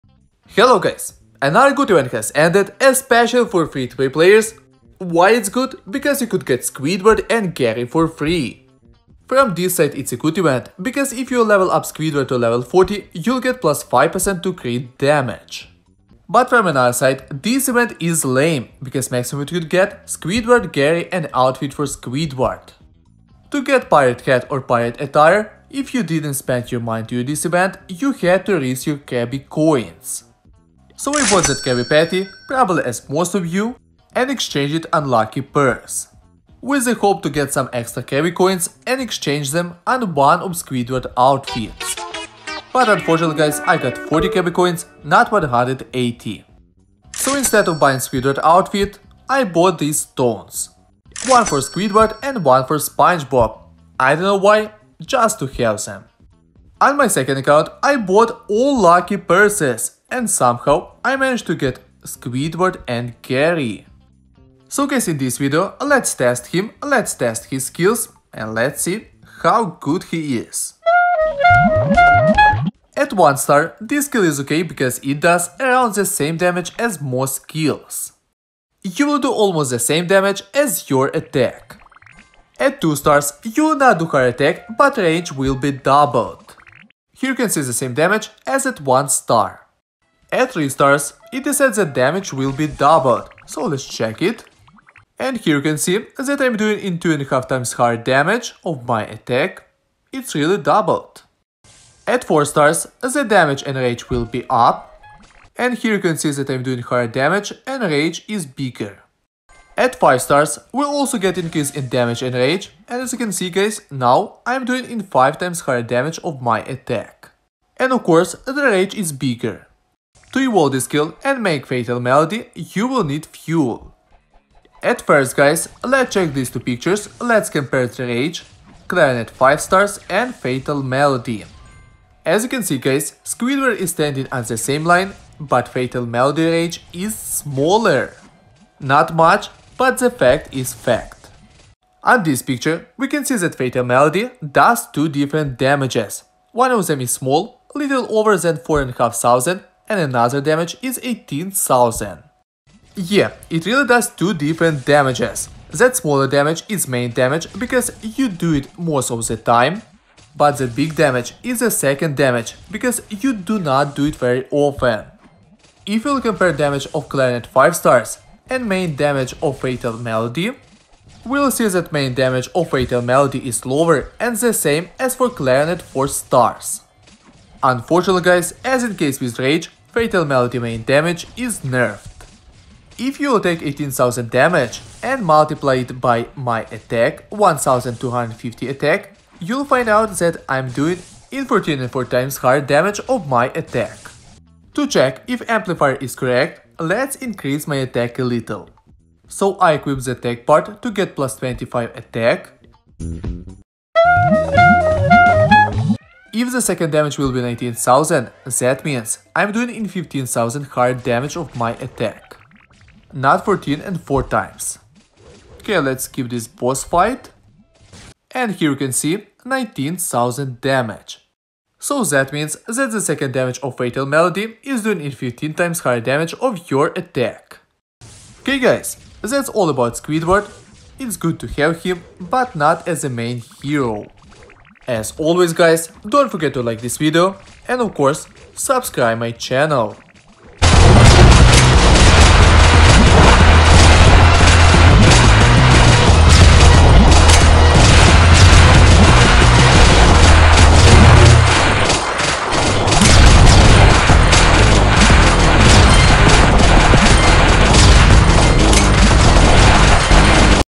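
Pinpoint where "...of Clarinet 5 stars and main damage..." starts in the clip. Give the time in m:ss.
2:46.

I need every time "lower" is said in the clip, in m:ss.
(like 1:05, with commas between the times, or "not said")
2:53.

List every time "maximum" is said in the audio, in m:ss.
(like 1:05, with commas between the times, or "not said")
0:19.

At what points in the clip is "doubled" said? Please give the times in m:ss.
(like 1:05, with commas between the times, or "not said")
1:25, 1:32, 1:40.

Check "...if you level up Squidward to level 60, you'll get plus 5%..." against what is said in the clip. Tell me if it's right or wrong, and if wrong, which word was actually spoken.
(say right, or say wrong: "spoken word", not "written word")
wrong: "40", not "60".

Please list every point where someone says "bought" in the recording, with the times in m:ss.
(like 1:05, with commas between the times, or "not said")
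0:31, 0:49, 0:57.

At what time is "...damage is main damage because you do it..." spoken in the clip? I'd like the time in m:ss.
2:36.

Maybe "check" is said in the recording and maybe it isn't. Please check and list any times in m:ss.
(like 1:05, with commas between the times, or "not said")
1:33, 2:06, 3:14.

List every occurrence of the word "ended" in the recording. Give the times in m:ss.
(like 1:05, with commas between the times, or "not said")
0:02.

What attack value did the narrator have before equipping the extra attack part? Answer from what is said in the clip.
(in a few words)
1250.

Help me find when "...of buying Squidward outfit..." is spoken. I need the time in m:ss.
0:47.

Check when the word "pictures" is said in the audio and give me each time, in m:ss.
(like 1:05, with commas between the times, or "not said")
2:06, 2:22.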